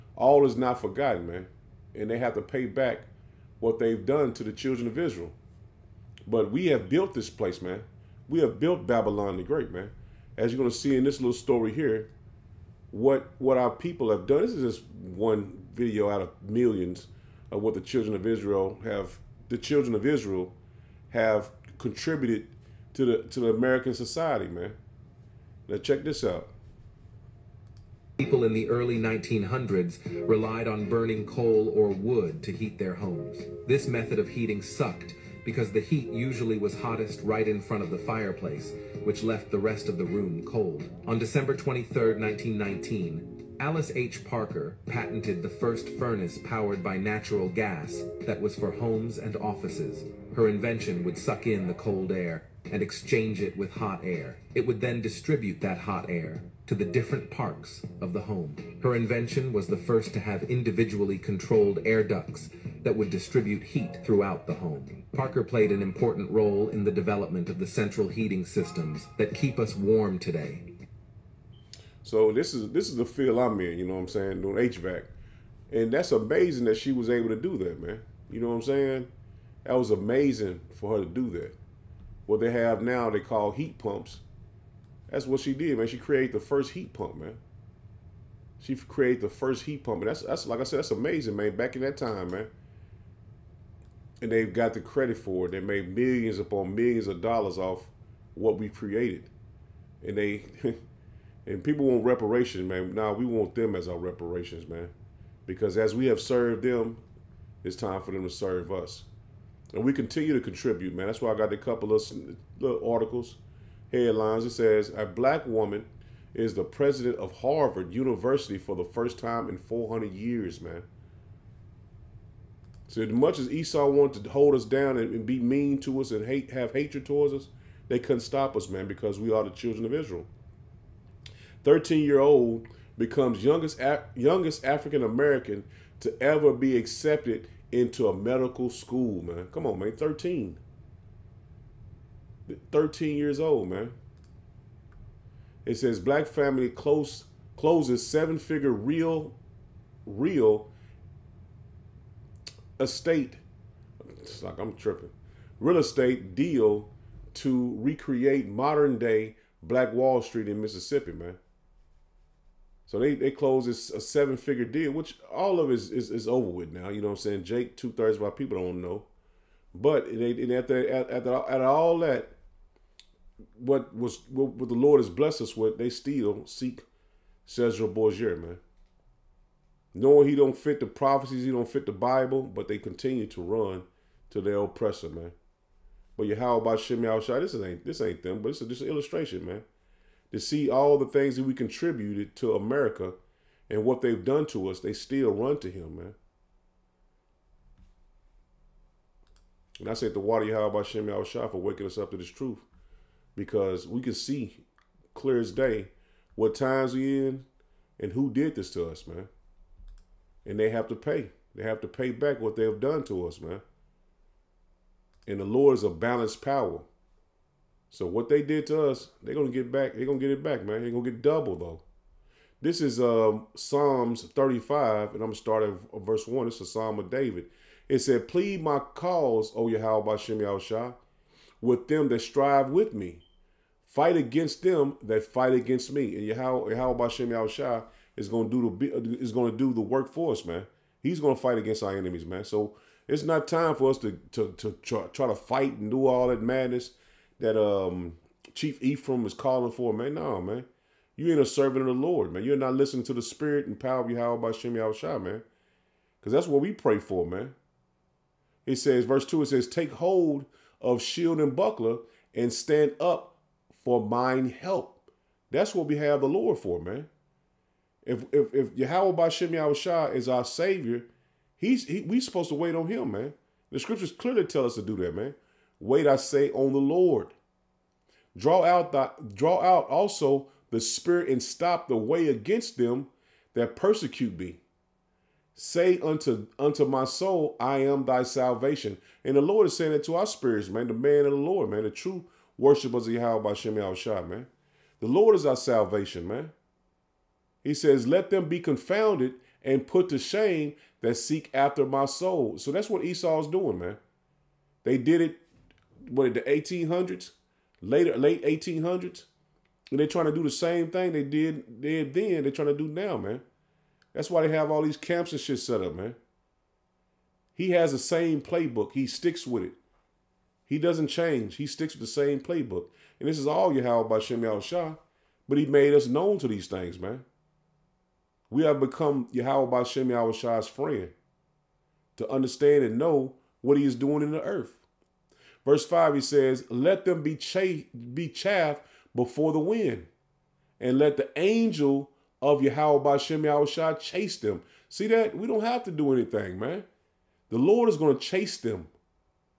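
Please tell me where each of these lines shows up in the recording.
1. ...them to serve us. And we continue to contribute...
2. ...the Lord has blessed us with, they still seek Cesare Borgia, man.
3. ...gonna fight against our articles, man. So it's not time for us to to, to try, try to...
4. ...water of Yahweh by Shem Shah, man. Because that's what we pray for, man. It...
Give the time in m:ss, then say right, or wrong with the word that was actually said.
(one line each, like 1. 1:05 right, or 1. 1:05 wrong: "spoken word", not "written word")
1. 1:48 right
2. 2:54 right
3. 4:01 wrong: "enemies", not "articles"
4. 4:13 wrong: "power", not "water".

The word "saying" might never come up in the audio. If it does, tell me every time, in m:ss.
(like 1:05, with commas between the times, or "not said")
1:14, 1:18, 2:47, 4:49.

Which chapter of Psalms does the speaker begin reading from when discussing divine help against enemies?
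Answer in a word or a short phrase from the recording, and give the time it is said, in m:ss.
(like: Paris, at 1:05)
Psalms 35, at 3:43.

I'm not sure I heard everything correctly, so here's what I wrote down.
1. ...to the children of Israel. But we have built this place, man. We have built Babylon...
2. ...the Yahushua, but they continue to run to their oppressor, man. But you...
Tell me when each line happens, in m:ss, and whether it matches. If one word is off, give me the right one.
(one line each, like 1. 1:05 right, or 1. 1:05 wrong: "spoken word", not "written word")
1. 0:04 right
2. 3:01 wrong: "Bible", not "Yahushua".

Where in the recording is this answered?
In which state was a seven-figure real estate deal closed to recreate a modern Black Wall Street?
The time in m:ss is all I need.
2:40.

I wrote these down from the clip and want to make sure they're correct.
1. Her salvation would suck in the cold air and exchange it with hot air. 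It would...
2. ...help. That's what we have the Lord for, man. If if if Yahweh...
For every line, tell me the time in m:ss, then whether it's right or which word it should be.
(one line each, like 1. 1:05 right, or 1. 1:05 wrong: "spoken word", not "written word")
1. 0:50 wrong: "invention", not "salvation"
2. 4:24 right.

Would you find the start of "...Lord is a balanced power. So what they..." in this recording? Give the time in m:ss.
3:35.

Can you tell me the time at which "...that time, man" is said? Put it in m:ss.
1:31.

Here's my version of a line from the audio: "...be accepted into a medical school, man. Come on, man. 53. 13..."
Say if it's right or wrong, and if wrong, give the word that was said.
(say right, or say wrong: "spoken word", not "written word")
wrong: "13", not "53".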